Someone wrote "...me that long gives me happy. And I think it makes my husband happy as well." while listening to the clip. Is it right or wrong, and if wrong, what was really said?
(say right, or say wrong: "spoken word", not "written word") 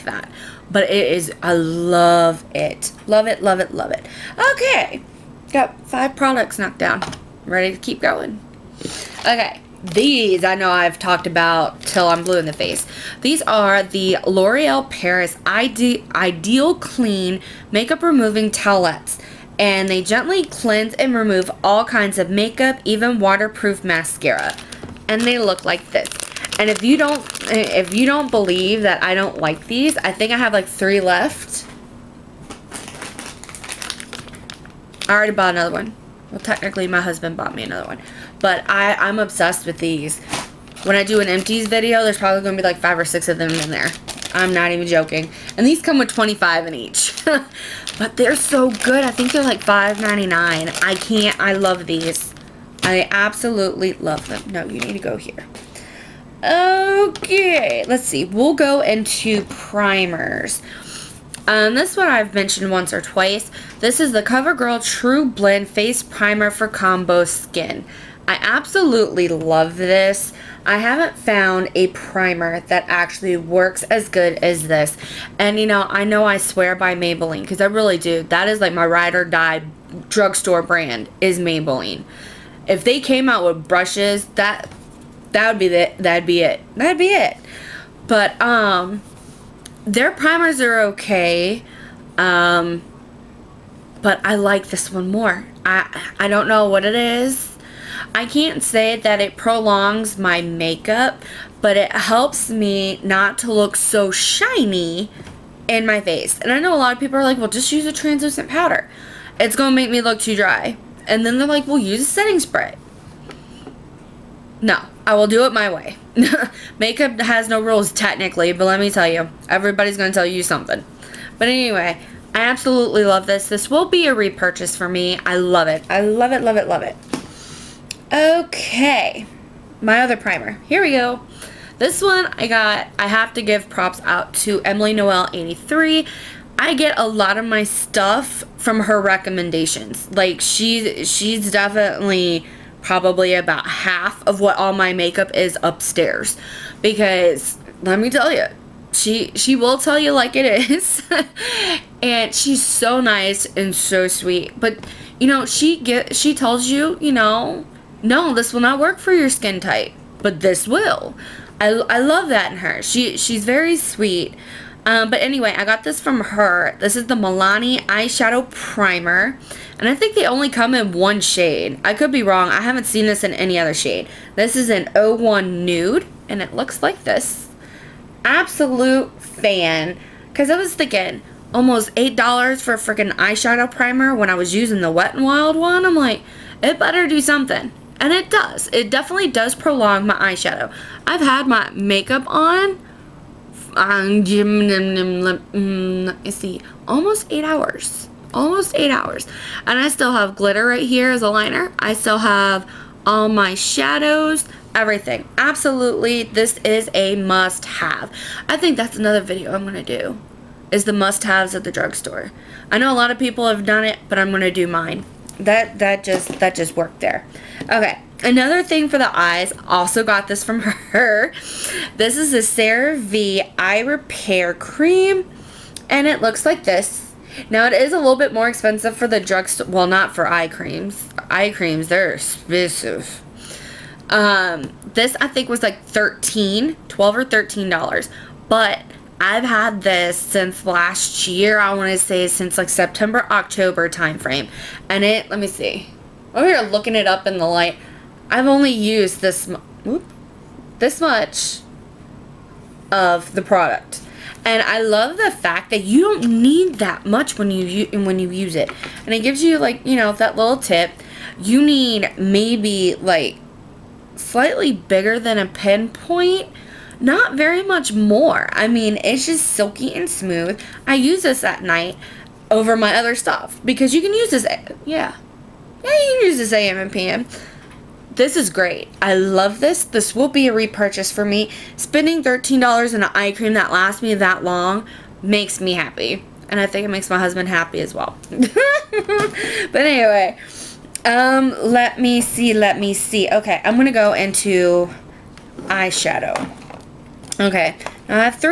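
wrong: "makes", not "gives".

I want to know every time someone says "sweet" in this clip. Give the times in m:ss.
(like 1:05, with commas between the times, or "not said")
2:34, 2:43.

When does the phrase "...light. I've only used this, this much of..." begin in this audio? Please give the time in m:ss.
4:07.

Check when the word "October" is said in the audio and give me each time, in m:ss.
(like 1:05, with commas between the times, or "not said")
4:03.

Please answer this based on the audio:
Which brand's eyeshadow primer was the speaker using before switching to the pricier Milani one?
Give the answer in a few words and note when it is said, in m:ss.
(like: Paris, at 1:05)
Wet n Wild, at 3:04.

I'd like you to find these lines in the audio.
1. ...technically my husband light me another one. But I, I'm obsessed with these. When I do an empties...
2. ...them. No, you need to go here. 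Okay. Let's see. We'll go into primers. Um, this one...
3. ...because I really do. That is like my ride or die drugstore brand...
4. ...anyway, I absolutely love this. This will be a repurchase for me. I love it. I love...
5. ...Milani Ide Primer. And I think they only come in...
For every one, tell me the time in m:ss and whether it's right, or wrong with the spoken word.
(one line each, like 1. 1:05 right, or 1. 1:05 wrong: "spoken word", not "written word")
1. 0:36 wrong: "bought", not "light"
2. 0:54 right
3. 1:17 right
4. 2:01 right
5. 2:47 wrong: "Eyeshadow", not "Ide".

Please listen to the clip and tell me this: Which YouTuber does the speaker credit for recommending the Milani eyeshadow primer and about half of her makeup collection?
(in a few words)
Emily Noel 83.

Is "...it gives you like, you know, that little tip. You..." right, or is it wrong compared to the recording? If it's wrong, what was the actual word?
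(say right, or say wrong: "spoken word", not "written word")
right.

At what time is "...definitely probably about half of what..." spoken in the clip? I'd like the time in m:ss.
2:21.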